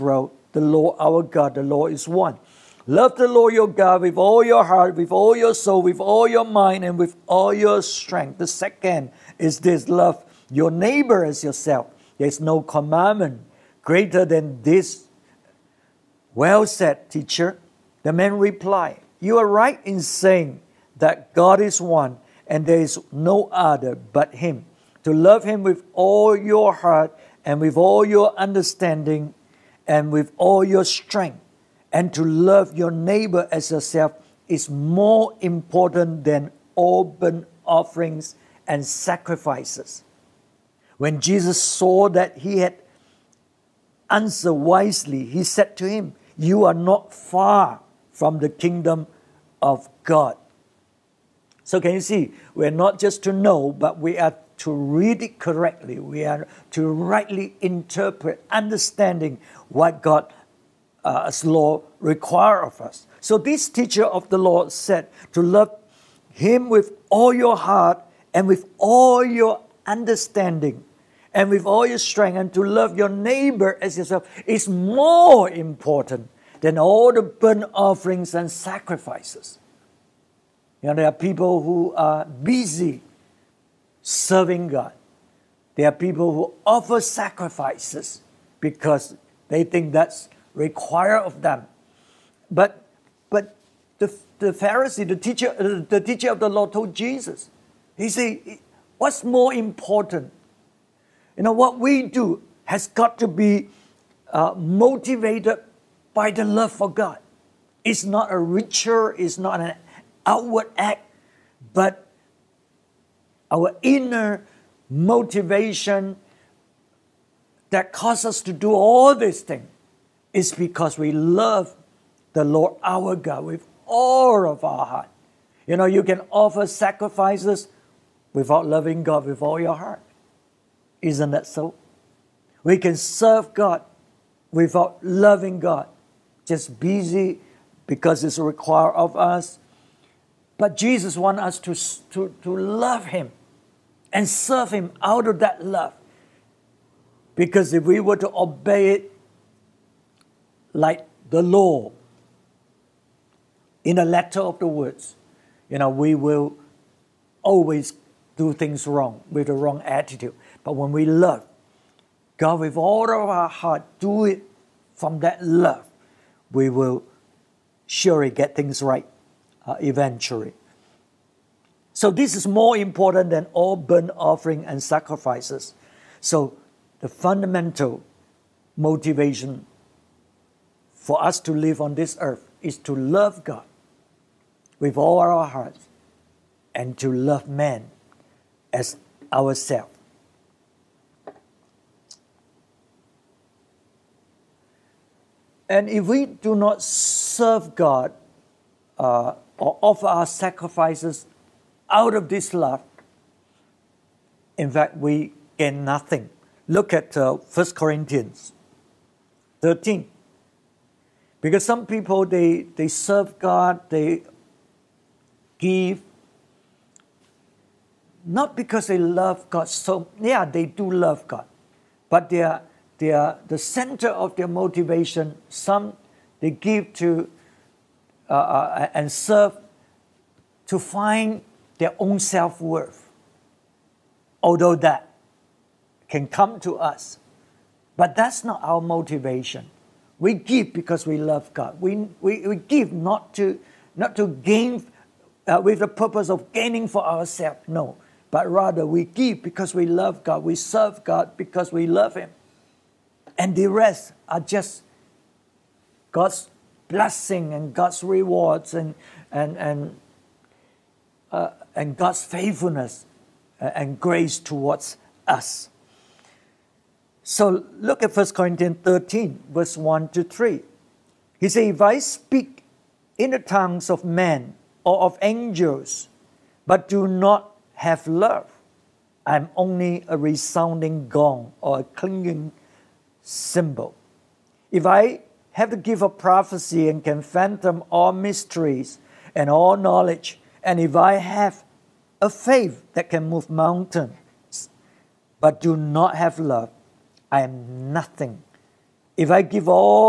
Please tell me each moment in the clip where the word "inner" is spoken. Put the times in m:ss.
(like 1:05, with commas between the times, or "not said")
1:53.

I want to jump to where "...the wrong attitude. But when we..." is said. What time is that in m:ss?
2:39.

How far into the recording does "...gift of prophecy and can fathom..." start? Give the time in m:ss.
4:45.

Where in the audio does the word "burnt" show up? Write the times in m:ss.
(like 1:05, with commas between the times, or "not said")
0:37, 1:17, 2:53.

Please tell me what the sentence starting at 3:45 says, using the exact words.
Some they give to uh, uh, and serve to find their own self worth, although that can come to us.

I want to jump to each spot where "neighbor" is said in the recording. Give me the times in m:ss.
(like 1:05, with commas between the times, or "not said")
0:10, 0:32, 1:13.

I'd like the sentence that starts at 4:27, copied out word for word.
So look at 1 Corinthians 13, verse 1 to 3.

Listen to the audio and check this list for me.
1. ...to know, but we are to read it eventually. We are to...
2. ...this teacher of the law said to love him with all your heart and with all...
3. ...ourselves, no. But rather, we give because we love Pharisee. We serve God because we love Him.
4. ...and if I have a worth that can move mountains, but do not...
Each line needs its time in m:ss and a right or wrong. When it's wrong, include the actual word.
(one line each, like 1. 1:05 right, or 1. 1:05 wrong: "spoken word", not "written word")
1. 0:53 wrong: "correctly", not "eventually"
2. 1:03 right
3. 4:07 wrong: "God", not "Pharisee"
4. 4:50 wrong: "faith", not "worth".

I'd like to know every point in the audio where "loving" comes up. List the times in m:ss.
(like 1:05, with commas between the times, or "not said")
2:08, 2:15.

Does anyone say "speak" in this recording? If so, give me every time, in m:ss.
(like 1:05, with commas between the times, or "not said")
4:31.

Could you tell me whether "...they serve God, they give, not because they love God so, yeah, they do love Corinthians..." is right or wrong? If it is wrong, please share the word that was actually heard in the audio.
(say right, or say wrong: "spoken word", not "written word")
wrong: "God", not "Corinthians".